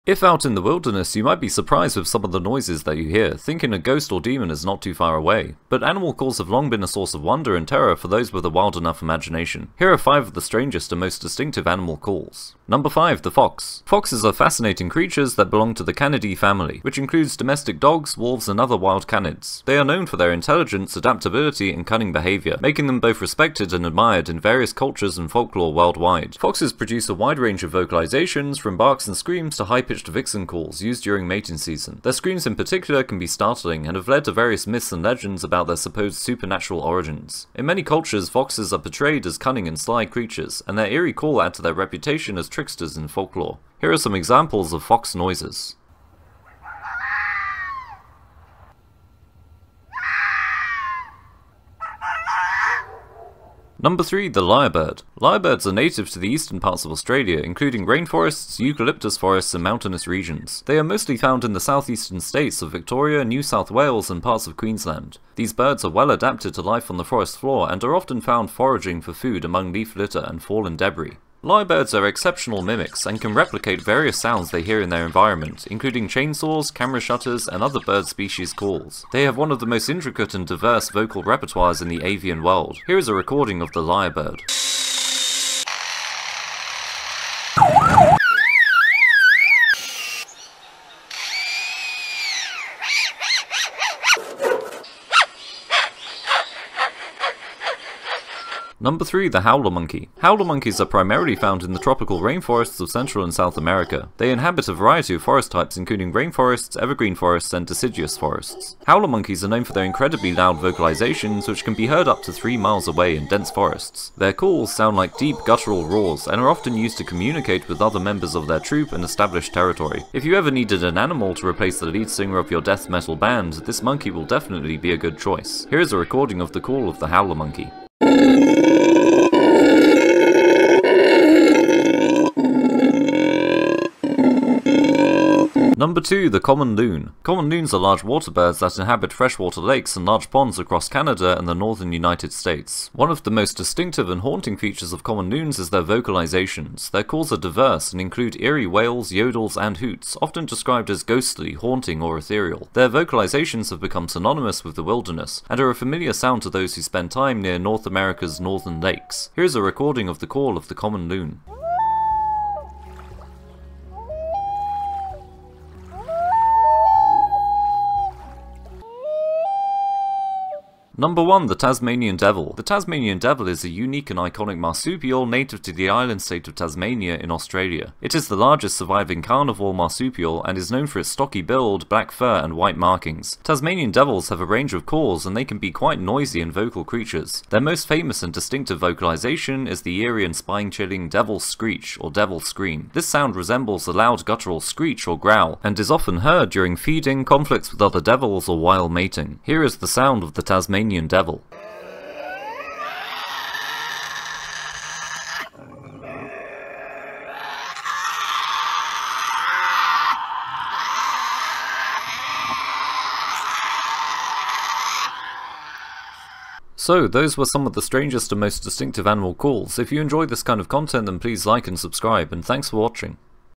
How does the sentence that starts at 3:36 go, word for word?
So, those were some of the strangest and most distinctive animal calls.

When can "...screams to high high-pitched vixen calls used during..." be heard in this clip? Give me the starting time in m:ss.
0:29.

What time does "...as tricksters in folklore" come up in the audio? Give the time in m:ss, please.
0:42.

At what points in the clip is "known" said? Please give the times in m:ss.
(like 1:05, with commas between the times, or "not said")
0:19, 1:49, 3:00.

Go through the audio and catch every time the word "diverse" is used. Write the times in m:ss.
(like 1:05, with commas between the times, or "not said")
1:20, 2:27.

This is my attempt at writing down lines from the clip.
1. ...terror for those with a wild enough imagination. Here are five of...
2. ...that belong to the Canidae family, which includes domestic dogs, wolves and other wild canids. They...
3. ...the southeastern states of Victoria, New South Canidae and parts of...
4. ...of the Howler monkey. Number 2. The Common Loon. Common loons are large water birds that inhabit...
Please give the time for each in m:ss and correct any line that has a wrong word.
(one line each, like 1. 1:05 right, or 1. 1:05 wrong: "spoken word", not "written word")
1. 0:07 right
2. 0:15 right
3. 1:01 wrong: "Wales", not "Canidae"
4. 2:06 right.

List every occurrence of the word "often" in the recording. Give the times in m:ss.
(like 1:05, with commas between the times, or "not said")
1:07, 1:56, 2:30, 3:15.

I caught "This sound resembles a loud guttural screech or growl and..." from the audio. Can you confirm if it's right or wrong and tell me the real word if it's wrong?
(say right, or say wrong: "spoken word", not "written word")
right.